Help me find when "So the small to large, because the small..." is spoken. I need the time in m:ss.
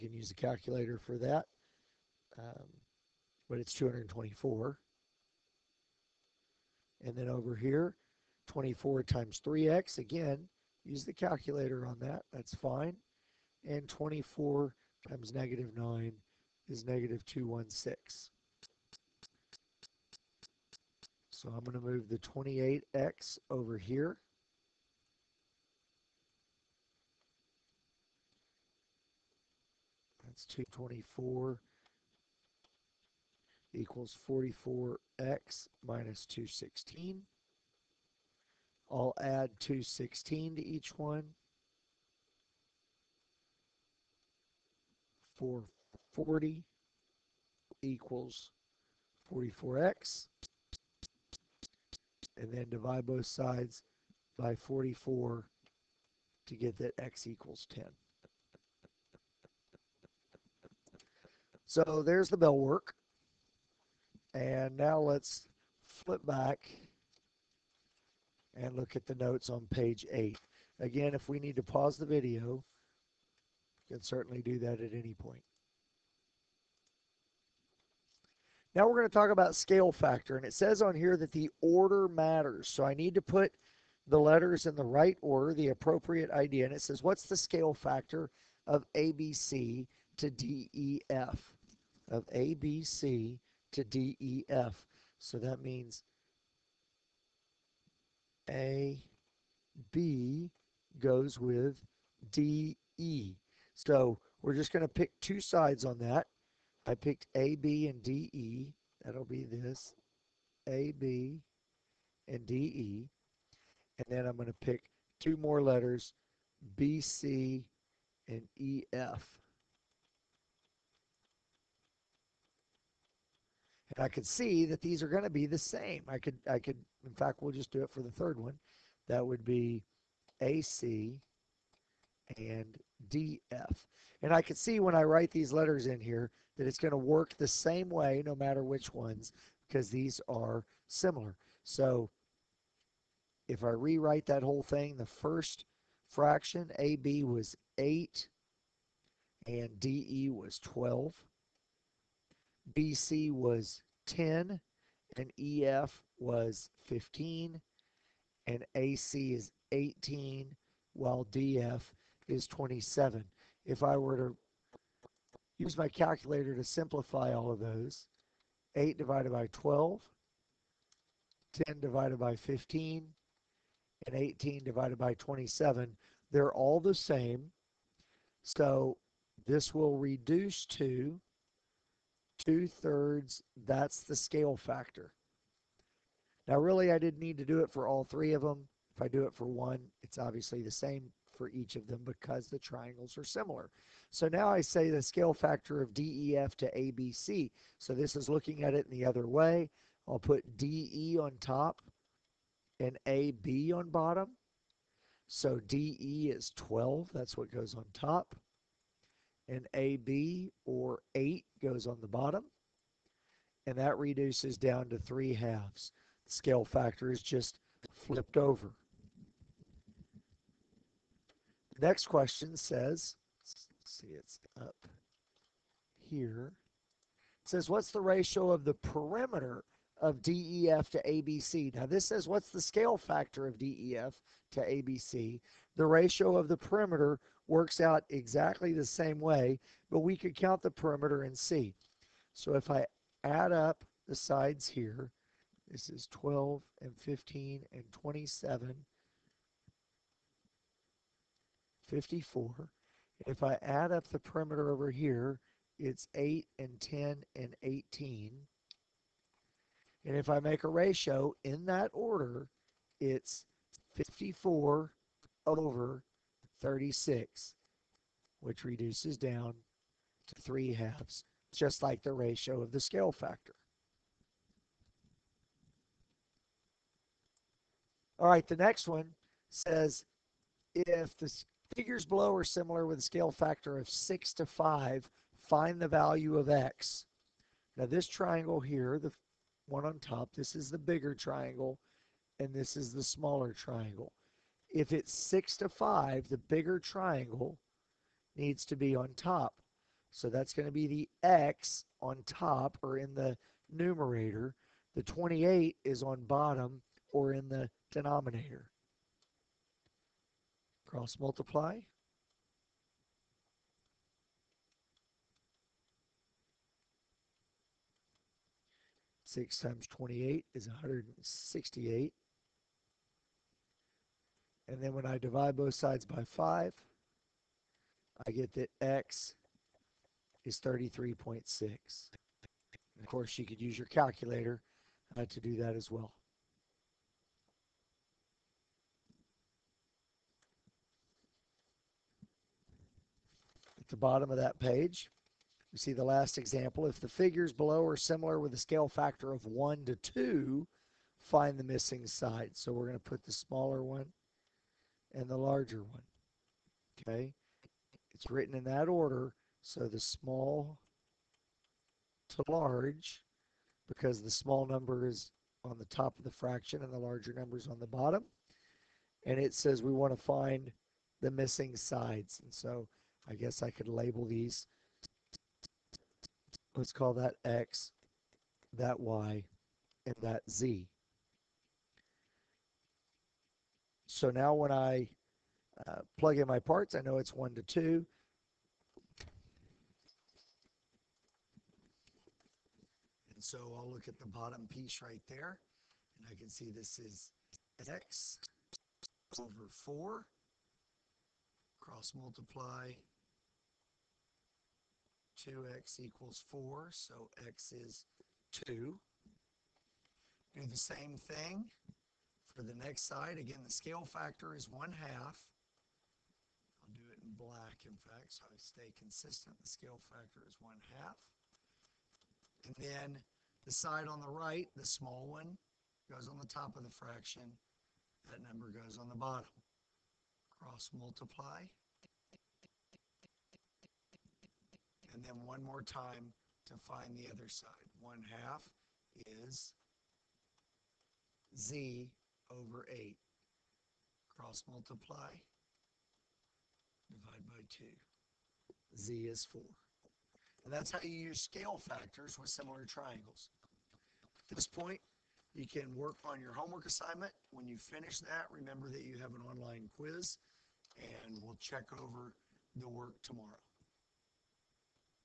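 5:59.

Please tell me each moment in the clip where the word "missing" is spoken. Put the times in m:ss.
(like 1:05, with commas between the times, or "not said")
5:51, 6:11.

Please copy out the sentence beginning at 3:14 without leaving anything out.
So now I say the scale factor of DEF to ABC.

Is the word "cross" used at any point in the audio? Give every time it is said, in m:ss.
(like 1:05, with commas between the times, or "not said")
5:10, 6:41, 7:10, 7:24.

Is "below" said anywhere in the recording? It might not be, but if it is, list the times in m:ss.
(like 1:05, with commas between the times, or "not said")
4:42, 5:47.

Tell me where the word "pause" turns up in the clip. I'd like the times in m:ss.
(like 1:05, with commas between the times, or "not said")
1:11.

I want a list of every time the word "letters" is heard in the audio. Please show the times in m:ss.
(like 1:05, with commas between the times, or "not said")
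1:24, 1:55, 2:15.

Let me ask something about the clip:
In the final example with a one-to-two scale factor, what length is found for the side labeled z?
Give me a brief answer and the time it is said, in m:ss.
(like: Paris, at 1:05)
4, at 7:28.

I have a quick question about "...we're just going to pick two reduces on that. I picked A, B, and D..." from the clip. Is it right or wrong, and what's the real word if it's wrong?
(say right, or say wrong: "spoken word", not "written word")
wrong: "sides", not "reduces".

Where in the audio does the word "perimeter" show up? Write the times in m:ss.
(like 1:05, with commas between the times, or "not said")
3:48, 3:56, 4:00, 4:14.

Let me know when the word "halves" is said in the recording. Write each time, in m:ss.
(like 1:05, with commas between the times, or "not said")
3:35, 4:30.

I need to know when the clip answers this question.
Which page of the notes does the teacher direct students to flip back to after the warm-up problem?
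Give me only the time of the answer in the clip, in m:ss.
1:09.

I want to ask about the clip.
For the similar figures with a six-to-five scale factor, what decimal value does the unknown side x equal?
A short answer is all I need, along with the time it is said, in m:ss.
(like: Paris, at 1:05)
33.6, at 5:30.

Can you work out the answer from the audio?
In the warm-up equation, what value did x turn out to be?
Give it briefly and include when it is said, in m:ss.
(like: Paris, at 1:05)
10, at 0:56.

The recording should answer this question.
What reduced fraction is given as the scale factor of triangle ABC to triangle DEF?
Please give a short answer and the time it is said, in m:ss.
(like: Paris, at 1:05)
2/3, at 3:02.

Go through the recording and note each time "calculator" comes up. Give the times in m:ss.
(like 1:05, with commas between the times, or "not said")
0:00, 0:11, 2:45, 5:33.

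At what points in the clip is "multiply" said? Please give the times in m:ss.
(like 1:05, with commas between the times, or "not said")
5:11, 6:42, 7:10, 7:24.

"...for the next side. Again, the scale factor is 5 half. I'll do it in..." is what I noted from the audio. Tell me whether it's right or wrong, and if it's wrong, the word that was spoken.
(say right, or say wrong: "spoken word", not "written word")
wrong: "1", not "5".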